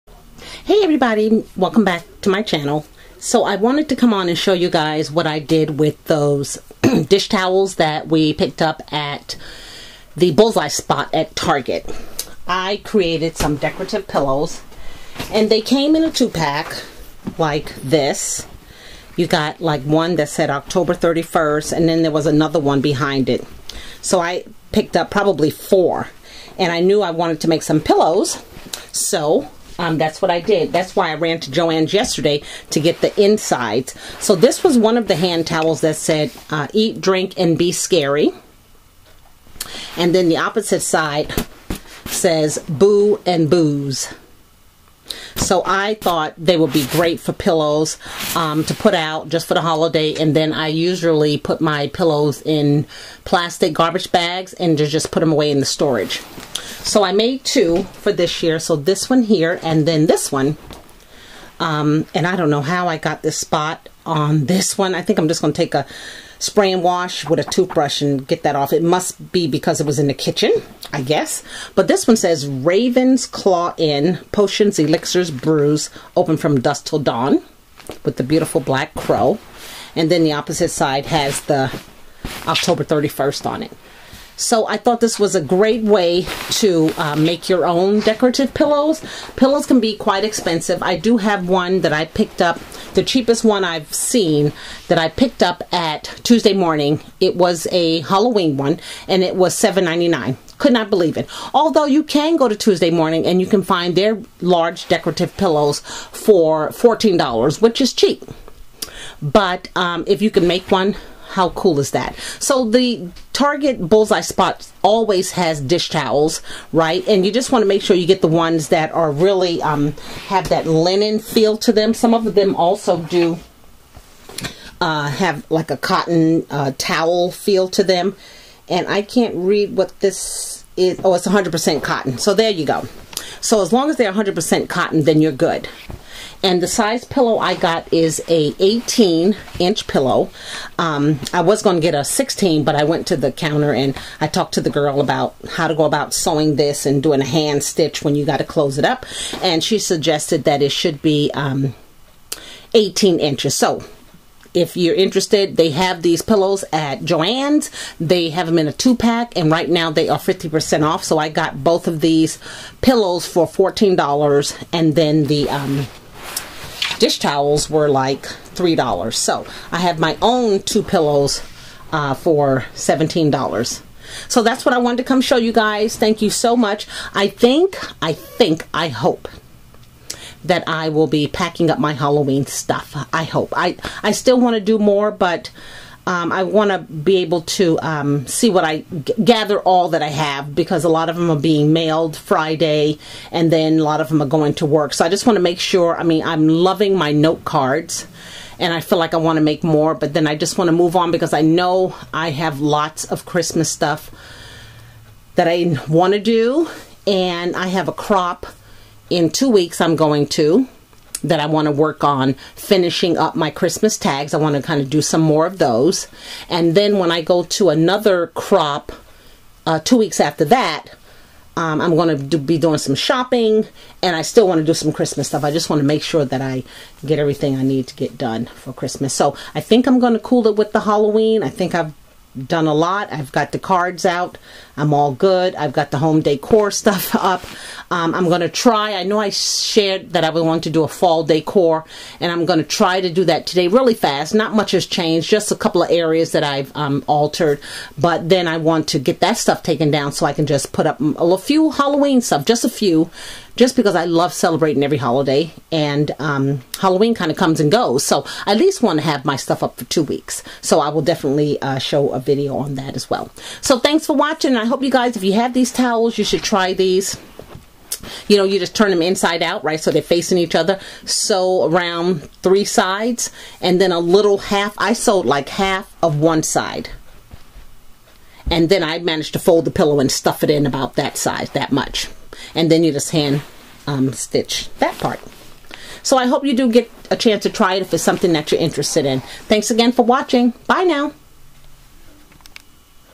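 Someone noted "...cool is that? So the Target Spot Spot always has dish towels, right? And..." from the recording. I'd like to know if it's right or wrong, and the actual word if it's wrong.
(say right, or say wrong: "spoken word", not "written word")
wrong: "Bullseye", not "Spot".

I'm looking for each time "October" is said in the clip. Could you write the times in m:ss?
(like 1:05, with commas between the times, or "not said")
0:20, 1:22.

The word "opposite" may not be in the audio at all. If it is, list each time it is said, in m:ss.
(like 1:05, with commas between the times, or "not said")
0:40, 1:20.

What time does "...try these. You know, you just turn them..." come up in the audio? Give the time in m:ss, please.
4:26.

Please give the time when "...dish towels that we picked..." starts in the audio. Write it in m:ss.
0:07.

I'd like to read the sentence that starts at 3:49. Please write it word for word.
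So I think I'm going to cool it with the Halloween.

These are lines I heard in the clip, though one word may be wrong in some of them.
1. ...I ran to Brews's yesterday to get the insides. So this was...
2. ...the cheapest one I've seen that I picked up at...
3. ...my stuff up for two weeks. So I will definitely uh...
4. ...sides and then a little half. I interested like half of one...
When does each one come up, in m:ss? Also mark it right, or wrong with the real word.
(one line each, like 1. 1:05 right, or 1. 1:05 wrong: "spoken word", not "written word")
1. 0:31 wrong: "Joann", not "Brews"
2. 1:32 right
3. 4:19 right
4. 4:32 wrong: "sewed", not "interested".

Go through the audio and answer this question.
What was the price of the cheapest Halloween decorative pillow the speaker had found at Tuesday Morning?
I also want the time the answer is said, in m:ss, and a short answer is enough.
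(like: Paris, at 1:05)
$7.99, at 1:39.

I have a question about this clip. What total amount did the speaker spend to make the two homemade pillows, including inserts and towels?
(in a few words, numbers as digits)
$17.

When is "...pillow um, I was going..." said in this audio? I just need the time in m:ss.
2:19.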